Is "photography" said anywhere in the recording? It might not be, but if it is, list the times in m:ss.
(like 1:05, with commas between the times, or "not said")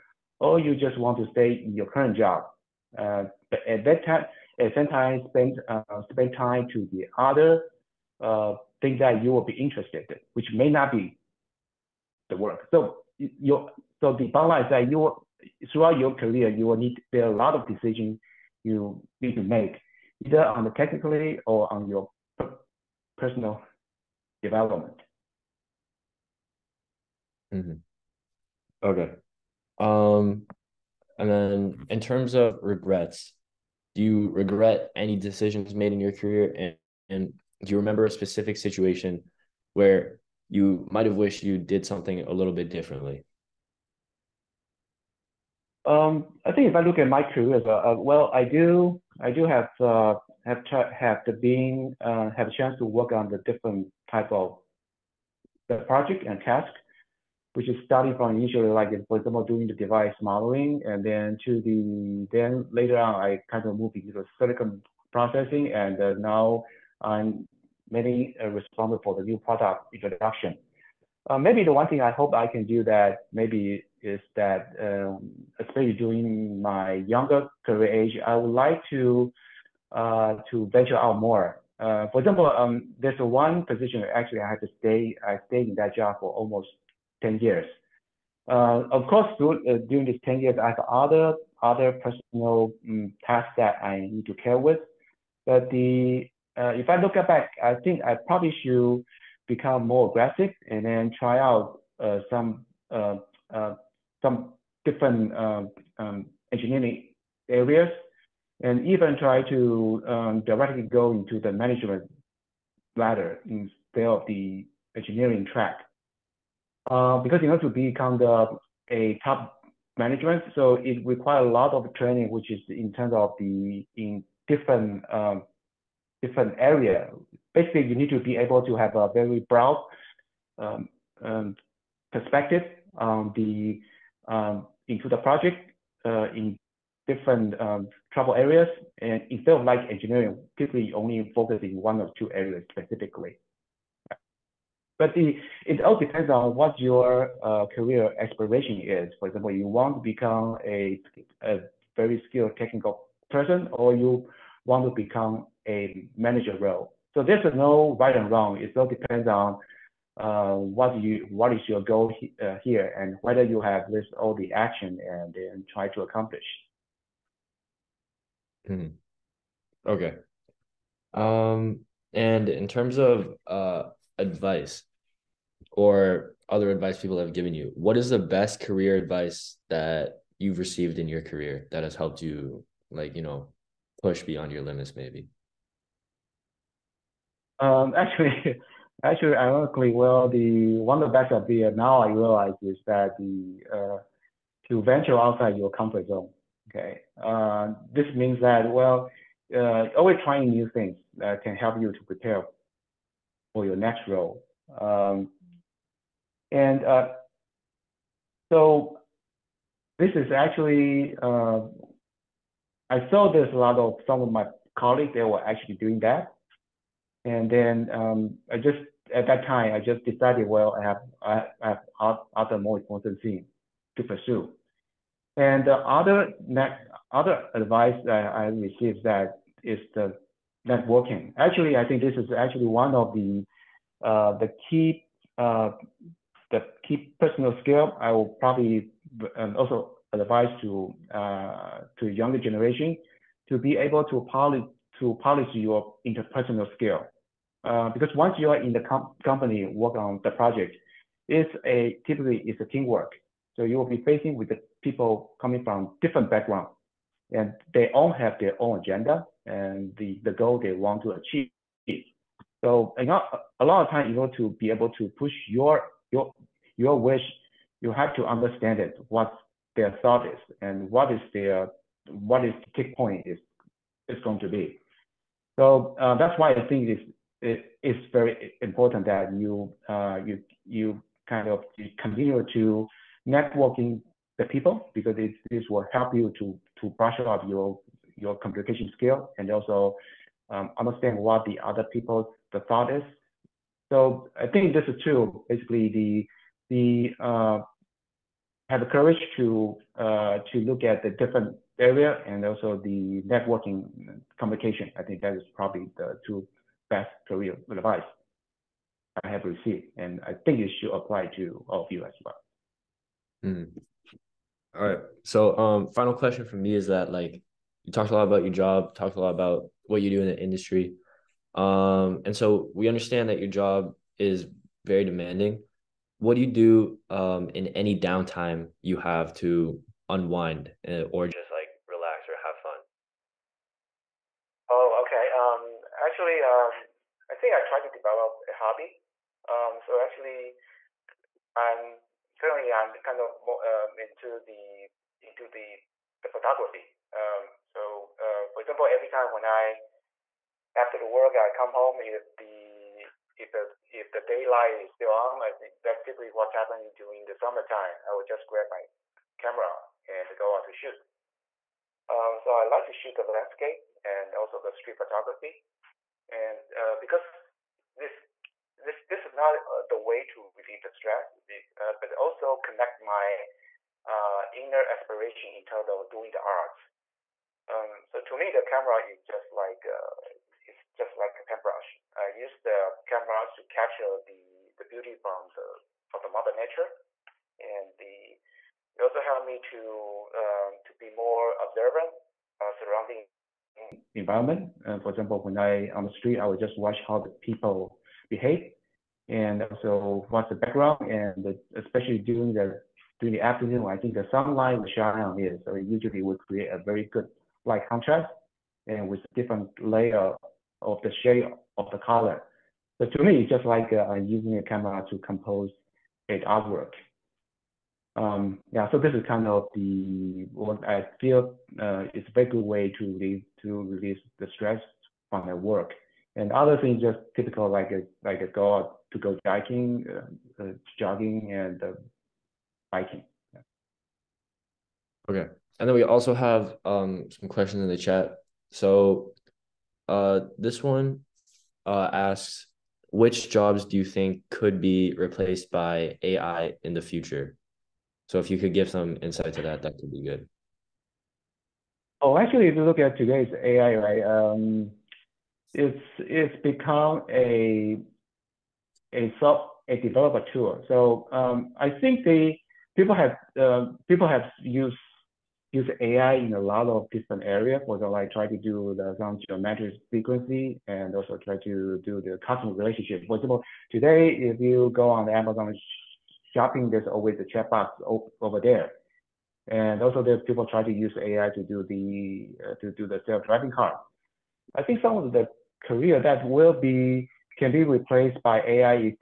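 5:46, 6:04.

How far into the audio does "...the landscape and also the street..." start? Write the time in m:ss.
6:03.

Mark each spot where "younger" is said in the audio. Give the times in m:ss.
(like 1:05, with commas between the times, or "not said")
1:17, 4:02.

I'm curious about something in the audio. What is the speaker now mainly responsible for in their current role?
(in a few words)
New product introduction.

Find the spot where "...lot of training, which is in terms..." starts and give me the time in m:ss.
2:01.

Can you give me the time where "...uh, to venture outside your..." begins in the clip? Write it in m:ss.
3:13.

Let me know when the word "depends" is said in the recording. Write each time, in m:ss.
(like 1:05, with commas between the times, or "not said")
2:25, 2:38.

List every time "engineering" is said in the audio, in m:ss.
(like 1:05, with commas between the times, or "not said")
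1:46, 1:54, 2:19.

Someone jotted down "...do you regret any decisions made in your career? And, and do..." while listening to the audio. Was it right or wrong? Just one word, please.
right.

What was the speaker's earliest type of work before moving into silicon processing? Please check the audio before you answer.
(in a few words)
Device modeling.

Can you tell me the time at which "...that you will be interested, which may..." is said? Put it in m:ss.
0:09.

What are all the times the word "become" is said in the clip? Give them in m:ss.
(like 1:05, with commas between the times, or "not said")
1:39, 1:57, 2:30, 2:34, 7:36.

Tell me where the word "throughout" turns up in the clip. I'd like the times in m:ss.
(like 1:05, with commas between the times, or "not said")
0:15.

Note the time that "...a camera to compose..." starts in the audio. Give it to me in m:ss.
6:54.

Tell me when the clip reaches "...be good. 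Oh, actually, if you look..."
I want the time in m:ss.
7:30.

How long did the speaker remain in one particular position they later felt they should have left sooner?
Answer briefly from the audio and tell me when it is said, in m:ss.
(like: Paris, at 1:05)
Almost 10 years, at 1:26.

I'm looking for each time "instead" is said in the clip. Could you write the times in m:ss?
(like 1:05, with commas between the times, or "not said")
1:53, 2:19.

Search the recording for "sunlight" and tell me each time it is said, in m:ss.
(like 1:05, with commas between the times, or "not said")
6:44.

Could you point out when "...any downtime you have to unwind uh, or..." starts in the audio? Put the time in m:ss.
5:27.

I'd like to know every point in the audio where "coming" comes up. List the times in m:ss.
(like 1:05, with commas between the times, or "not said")
4:15.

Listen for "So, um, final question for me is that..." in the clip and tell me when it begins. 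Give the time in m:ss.
5:15.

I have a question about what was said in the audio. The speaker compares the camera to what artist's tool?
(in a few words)
A paintbrush.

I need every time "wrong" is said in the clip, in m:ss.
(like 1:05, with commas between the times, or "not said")
2:38.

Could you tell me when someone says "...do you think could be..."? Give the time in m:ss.
7:23.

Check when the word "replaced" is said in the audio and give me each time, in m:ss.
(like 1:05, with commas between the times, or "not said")
7:25, 8:07.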